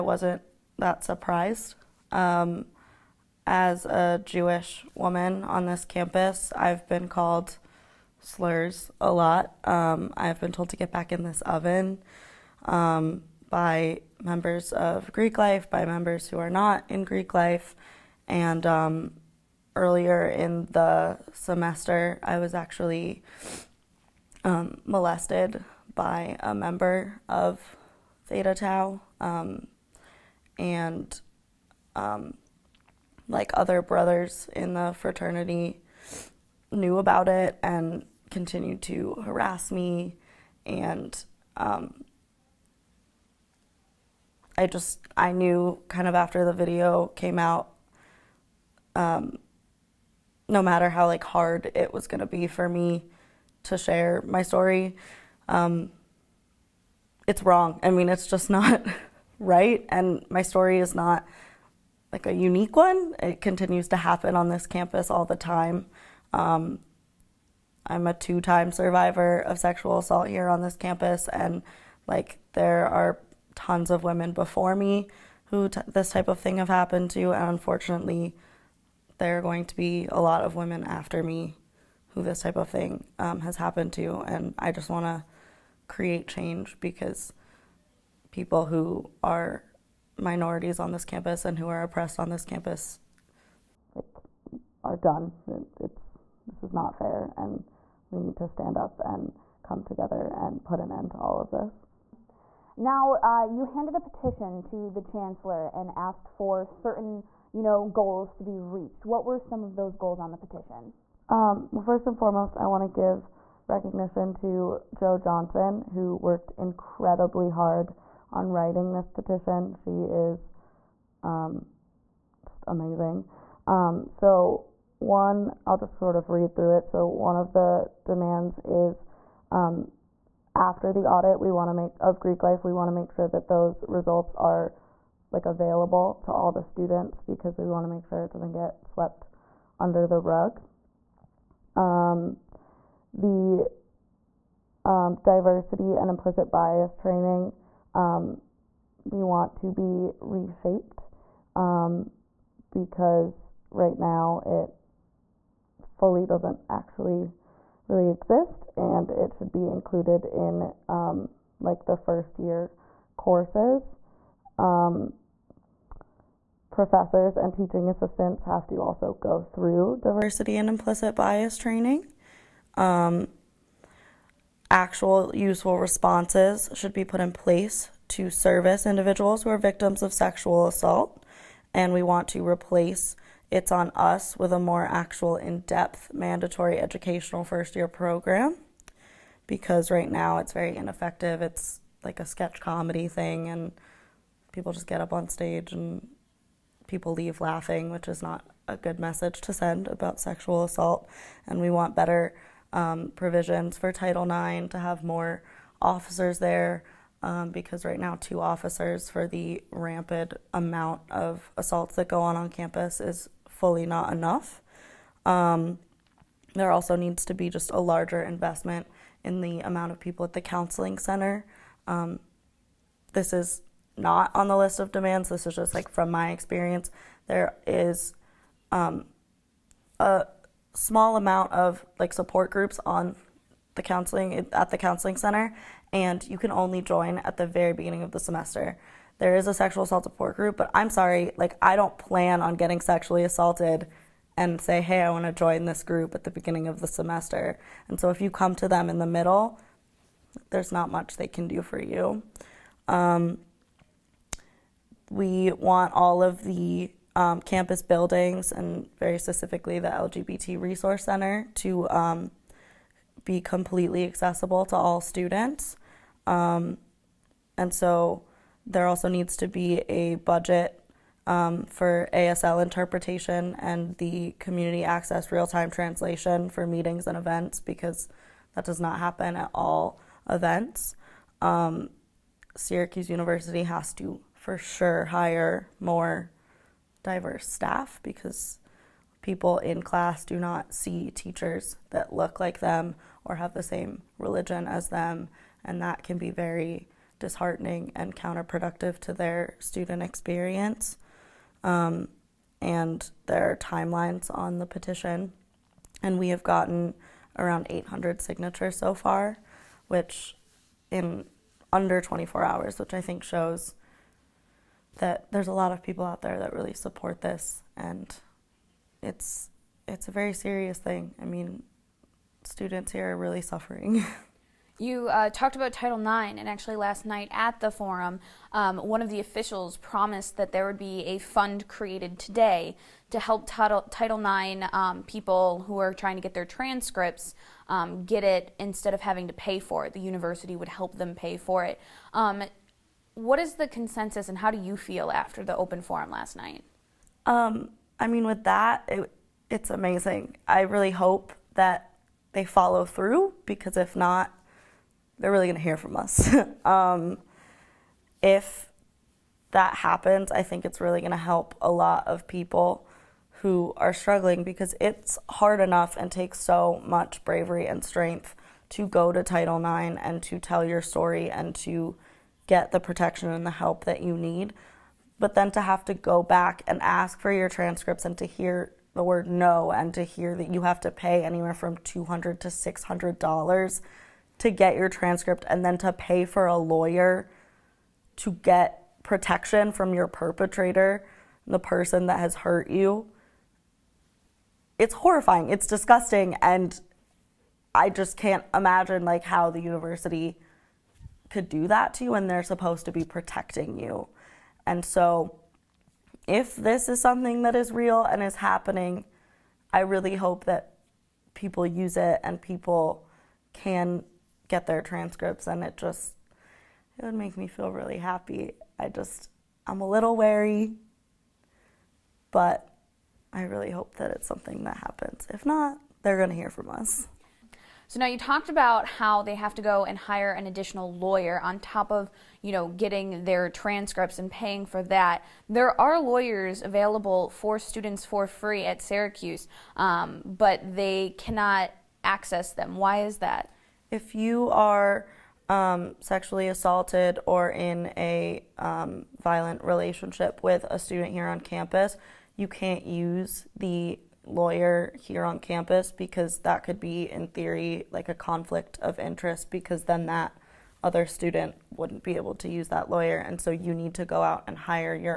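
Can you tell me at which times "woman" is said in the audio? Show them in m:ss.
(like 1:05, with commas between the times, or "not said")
0:04.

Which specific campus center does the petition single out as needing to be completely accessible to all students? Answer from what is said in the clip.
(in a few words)
LGBT Resource Center.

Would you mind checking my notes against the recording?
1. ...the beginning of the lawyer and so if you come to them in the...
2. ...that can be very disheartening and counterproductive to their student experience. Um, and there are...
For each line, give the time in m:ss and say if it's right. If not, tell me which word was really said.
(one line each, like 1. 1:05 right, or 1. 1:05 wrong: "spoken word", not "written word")
1. 4:06 wrong: "semester", not "lawyer"
2. 4:55 right.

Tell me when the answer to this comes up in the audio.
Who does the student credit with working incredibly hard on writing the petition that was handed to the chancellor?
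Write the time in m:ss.
1:54.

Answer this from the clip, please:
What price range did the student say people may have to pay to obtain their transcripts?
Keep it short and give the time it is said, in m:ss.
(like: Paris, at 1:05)
$200 to $600, at 6:21.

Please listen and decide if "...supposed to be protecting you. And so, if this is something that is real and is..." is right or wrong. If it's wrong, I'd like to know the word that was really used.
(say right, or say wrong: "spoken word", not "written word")
right.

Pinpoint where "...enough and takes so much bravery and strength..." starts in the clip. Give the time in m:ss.
6:05.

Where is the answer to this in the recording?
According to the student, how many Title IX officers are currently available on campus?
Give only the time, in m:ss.
3:28.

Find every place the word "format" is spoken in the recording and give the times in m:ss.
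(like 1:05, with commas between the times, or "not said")
not said.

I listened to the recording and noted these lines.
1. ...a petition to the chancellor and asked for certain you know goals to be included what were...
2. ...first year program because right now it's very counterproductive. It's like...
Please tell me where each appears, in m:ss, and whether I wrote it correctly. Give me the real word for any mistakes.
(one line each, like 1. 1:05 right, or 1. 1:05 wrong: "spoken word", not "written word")
1. 1:43 wrong: "reached", not "included"
2. 3:07 wrong: "ineffective", not "counterproductive".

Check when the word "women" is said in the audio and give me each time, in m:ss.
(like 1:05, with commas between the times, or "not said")
1:14, 1:20.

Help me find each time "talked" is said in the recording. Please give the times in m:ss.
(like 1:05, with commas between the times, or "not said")
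5:25, 7:08.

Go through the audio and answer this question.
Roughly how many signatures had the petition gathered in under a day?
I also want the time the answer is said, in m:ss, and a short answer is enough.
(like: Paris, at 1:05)
800, at 5:07.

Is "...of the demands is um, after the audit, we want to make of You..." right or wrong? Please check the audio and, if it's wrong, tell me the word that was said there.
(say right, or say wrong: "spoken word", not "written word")
wrong: "Greek", not "You".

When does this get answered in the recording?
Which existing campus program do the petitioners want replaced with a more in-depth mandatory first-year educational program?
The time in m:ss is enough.
3:03.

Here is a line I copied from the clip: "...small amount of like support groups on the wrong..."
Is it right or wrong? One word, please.
wrong.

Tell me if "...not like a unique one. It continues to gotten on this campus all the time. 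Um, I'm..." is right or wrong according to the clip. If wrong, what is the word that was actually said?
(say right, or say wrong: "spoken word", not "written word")
wrong: "happen", not "gotten".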